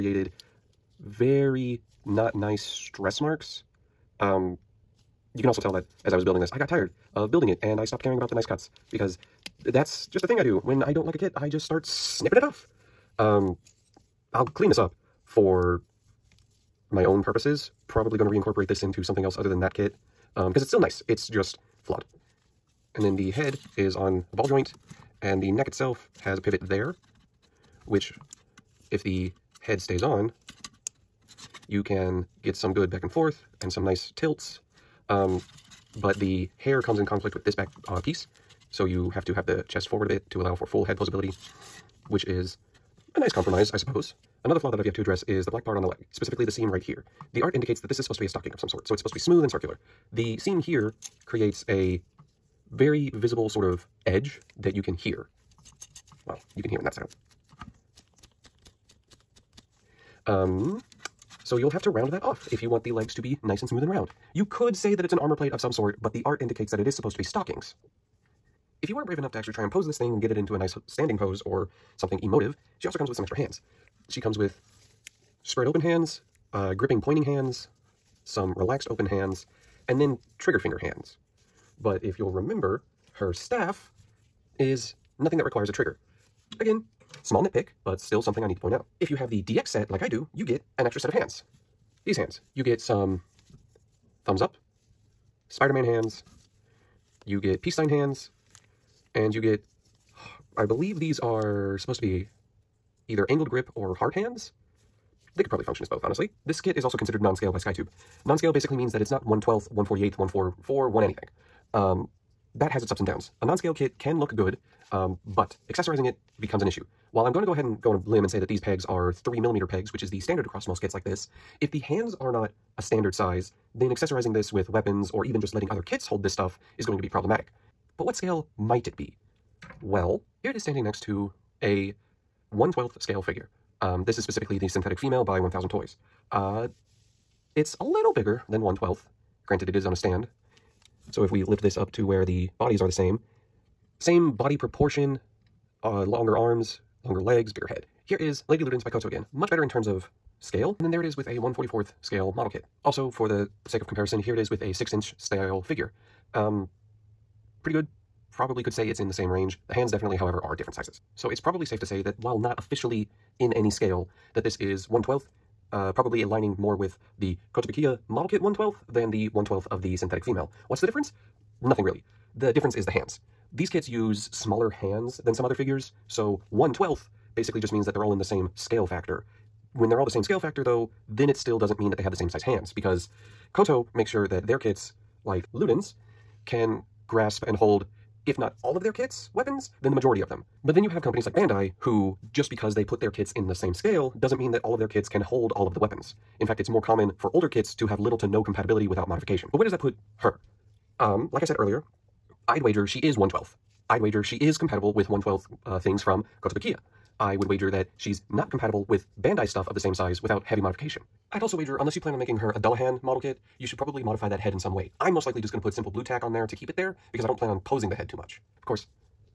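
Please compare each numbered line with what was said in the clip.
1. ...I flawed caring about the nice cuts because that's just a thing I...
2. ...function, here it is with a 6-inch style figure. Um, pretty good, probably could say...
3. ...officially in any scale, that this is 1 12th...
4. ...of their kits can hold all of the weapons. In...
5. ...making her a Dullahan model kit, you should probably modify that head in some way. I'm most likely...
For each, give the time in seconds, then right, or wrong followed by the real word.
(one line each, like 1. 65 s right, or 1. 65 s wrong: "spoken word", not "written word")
1. 7 s wrong: "stopped", not "flawed"
2. 153 s wrong: "comparison", not "function"
3. 162 s right
4. 194 s right
5. 212 s right.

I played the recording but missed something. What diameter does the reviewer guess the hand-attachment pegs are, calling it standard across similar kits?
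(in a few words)
3 millimeters.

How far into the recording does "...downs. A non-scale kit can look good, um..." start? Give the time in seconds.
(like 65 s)
113 s.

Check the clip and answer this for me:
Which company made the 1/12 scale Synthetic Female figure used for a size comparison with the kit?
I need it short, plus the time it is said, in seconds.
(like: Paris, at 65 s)
1000 Toys, at 135 s.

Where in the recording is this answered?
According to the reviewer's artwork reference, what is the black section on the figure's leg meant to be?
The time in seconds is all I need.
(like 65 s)
67 s.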